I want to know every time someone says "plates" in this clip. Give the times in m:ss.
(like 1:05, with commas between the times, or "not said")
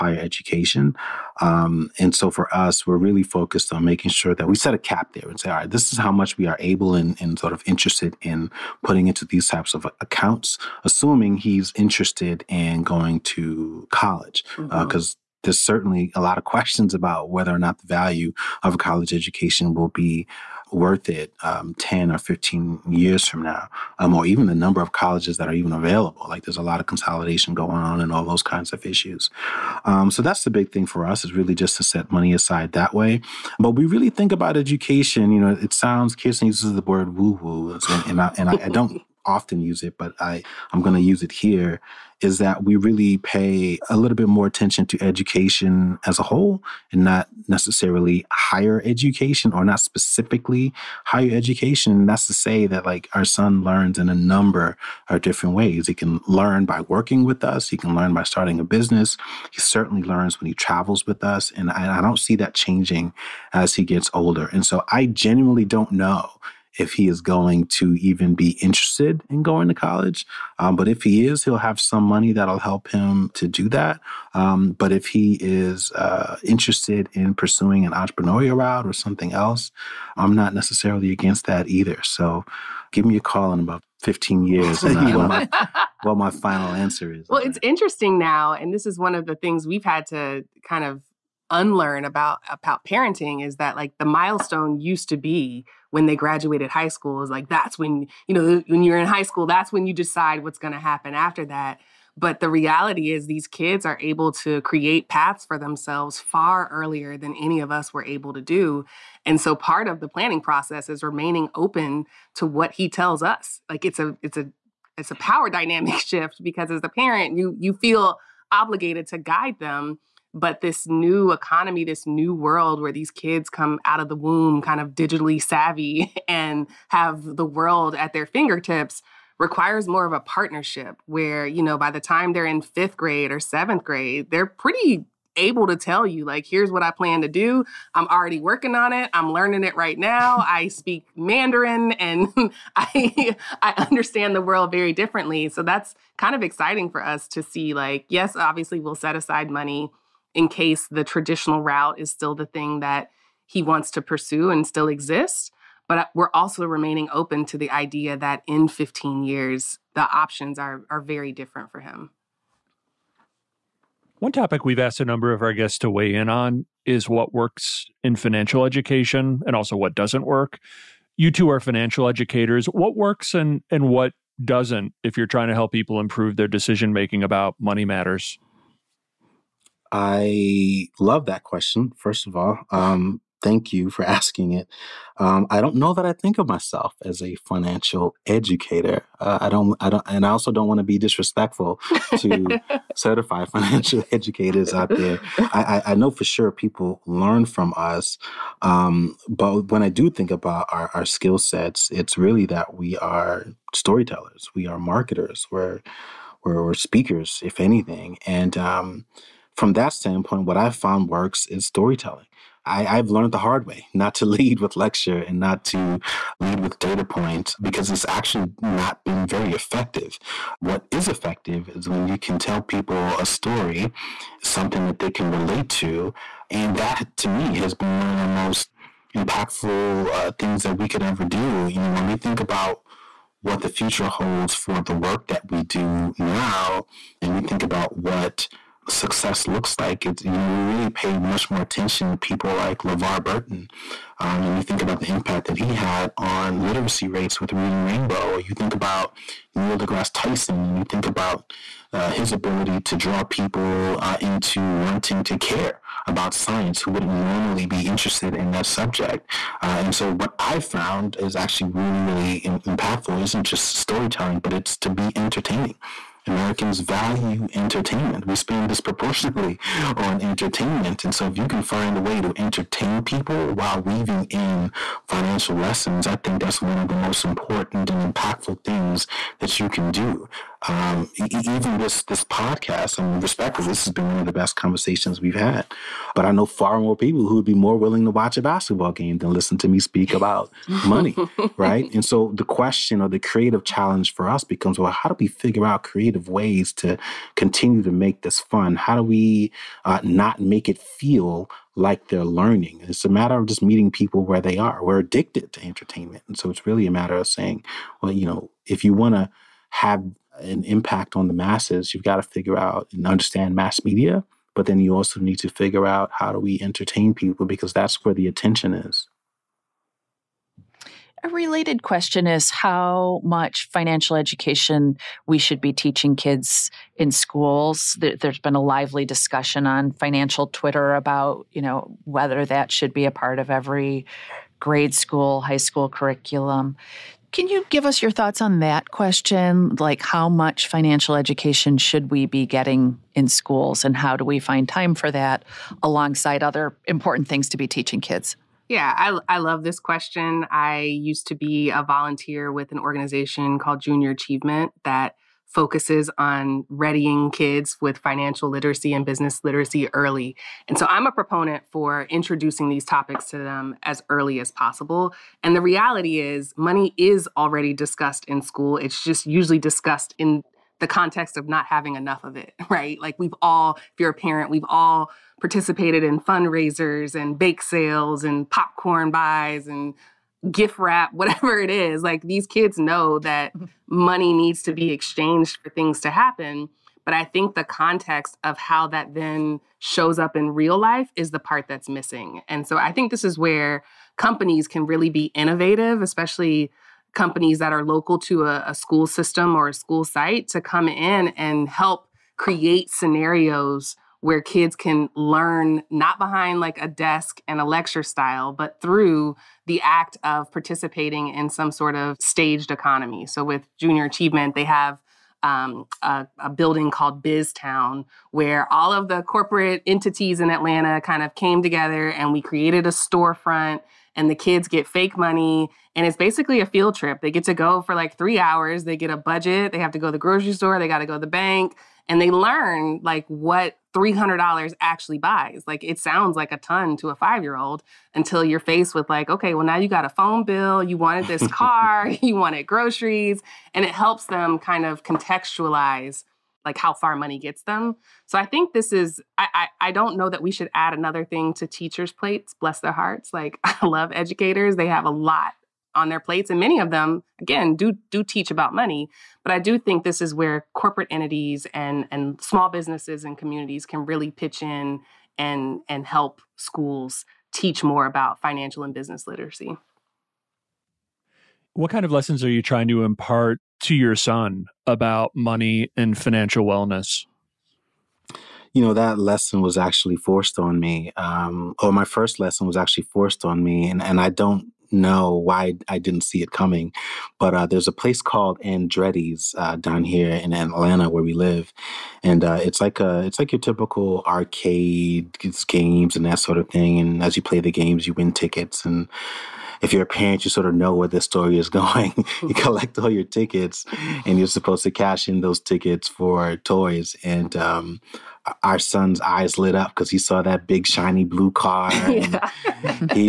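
7:32, 7:36.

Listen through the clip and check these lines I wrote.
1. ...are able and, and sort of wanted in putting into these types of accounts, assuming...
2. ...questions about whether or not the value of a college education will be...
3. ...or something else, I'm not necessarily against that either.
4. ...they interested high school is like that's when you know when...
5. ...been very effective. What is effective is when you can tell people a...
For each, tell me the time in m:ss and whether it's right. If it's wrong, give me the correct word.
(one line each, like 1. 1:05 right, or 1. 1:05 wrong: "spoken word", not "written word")
1. 0:06 wrong: "interested", not "wanted"
2. 0:16 right
3. 1:18 right
4. 1:36 wrong: "graduated", not "interested"
5. 3:39 right.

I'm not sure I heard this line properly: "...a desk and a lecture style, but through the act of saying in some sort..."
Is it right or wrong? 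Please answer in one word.
wrong.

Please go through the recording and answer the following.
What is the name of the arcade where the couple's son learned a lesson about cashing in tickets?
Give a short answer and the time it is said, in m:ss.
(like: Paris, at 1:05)
Andretti's, at 8:08.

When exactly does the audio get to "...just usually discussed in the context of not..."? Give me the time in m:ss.
6:09.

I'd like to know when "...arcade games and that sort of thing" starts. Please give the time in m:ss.
8:14.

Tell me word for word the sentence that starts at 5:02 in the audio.
It's a matter of just meeting people where they are.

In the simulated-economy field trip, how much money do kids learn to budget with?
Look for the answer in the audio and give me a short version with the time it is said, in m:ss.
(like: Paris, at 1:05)
$300, at 7:13.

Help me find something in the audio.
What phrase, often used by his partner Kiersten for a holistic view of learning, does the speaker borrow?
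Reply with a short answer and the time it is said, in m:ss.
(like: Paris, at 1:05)
woo woo, at 0:37.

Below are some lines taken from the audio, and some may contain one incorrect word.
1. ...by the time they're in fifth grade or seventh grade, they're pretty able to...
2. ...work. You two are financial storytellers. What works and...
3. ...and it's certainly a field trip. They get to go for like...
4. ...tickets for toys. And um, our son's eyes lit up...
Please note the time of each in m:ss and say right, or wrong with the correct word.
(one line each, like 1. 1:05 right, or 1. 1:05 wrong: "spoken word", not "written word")
1. 2:11 right
2. 2:50 wrong: "educators", not "storytellers"
3. 7:05 wrong: "basically", not "certainly"
4. 8:25 right.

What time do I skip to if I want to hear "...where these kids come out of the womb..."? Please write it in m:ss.
2:02.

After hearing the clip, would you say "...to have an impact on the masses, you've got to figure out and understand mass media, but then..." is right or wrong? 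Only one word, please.
right.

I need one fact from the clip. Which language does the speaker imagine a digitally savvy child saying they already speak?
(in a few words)
Mandarin.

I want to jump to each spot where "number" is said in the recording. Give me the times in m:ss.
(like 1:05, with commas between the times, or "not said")
0:24, 0:54, 2:45.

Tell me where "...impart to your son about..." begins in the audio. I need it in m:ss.
7:53.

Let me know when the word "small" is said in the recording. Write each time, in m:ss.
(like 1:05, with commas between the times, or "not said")
7:42.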